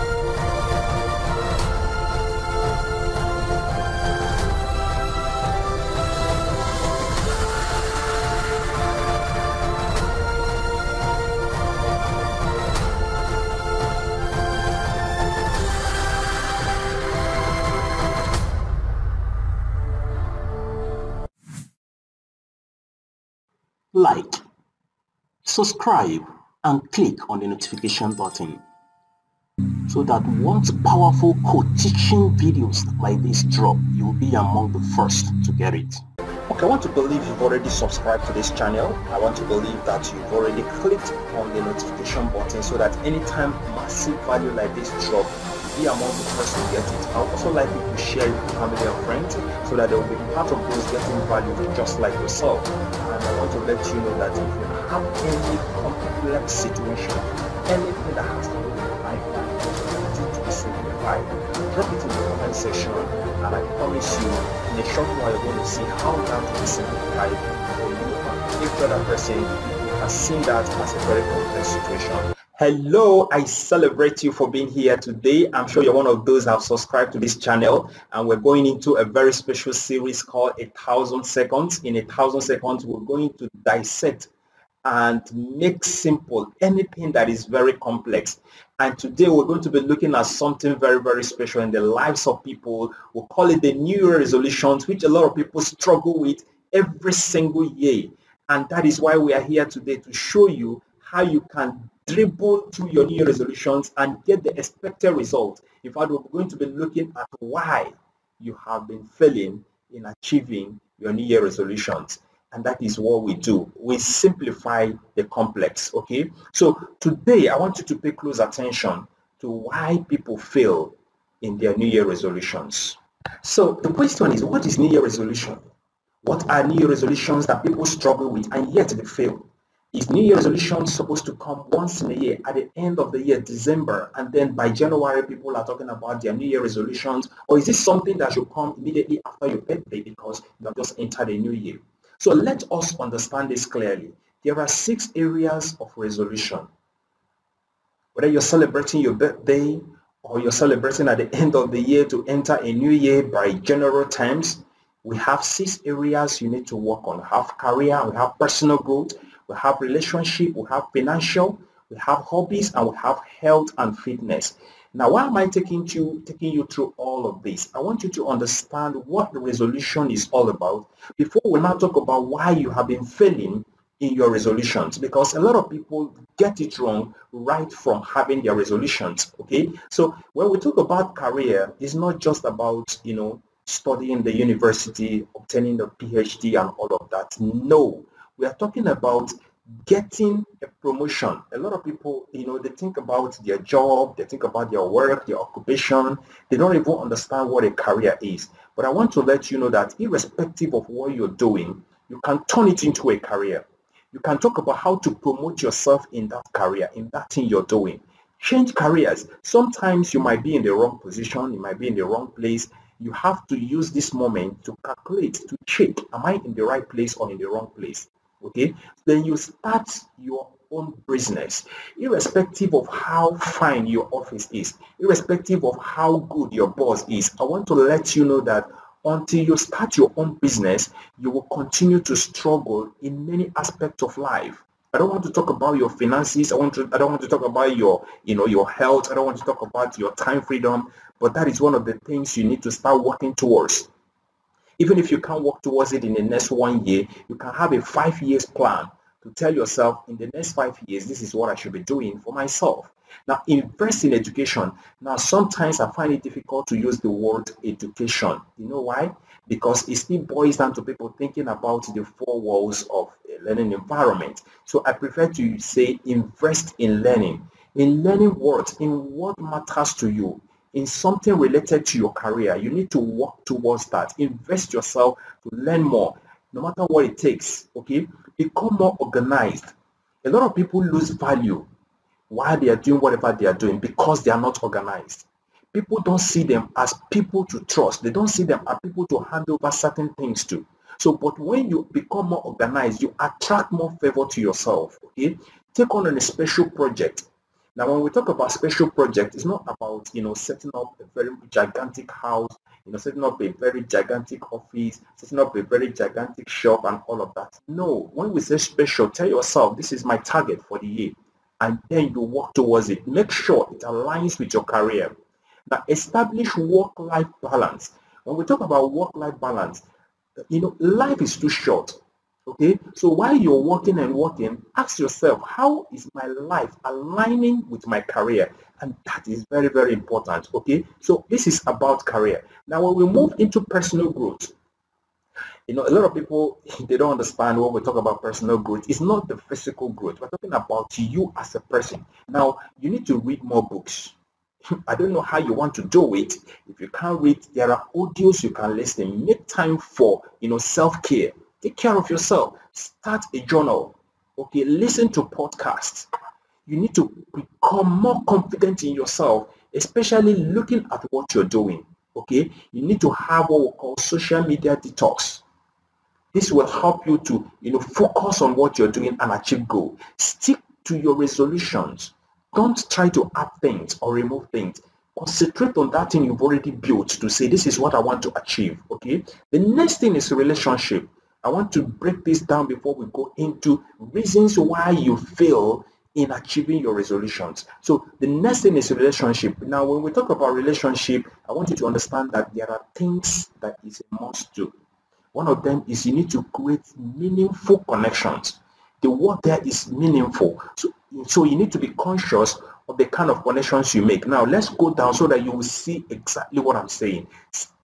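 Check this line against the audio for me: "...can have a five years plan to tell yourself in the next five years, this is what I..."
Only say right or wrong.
right.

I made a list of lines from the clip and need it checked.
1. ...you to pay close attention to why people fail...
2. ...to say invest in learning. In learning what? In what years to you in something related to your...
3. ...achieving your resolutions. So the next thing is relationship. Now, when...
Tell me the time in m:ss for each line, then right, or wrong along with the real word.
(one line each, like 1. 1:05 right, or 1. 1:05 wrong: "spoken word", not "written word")
1. 1:57 right
2. 4:25 wrong: "matters", not "years"
3. 6:26 right.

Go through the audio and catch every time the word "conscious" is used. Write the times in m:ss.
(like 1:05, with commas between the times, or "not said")
6:41.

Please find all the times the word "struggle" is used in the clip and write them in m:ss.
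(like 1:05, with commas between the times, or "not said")
1:35, 2:07, 3:52.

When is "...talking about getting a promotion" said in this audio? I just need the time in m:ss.
3:08.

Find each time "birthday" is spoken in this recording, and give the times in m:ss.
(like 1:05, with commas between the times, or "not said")
2:19, 2:29.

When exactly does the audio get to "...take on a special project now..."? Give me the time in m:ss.
4:55.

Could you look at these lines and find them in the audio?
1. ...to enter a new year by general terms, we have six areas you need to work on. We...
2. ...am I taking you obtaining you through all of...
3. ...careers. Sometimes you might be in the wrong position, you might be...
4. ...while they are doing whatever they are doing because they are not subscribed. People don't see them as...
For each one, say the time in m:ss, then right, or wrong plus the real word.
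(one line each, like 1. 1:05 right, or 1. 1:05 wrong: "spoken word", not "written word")
1. 2:32 right
2. 2:45 wrong: "taking", not "obtaining"
3. 3:28 right
4. 4:42 wrong: "organized", not "subscribed".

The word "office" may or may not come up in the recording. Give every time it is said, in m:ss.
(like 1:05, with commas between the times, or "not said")
3:44, 5:04.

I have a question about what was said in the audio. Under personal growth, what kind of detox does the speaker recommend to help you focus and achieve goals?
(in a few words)
social media detox.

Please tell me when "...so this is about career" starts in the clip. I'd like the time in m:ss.
5:30.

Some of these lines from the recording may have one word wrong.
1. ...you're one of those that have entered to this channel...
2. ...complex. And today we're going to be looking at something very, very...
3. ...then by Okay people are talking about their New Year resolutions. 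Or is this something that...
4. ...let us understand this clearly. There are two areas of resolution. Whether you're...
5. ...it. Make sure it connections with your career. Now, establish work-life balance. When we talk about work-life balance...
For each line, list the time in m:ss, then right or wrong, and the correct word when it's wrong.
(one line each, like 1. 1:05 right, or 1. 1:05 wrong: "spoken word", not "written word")
1. 1:15 wrong: "subscribed", not "entered"
2. 1:27 right
3. 2:14 wrong: "January", not "Okay"
4. 2:22 wrong: "six", not "two"
5. 5:12 wrong: "aligns", not "connections".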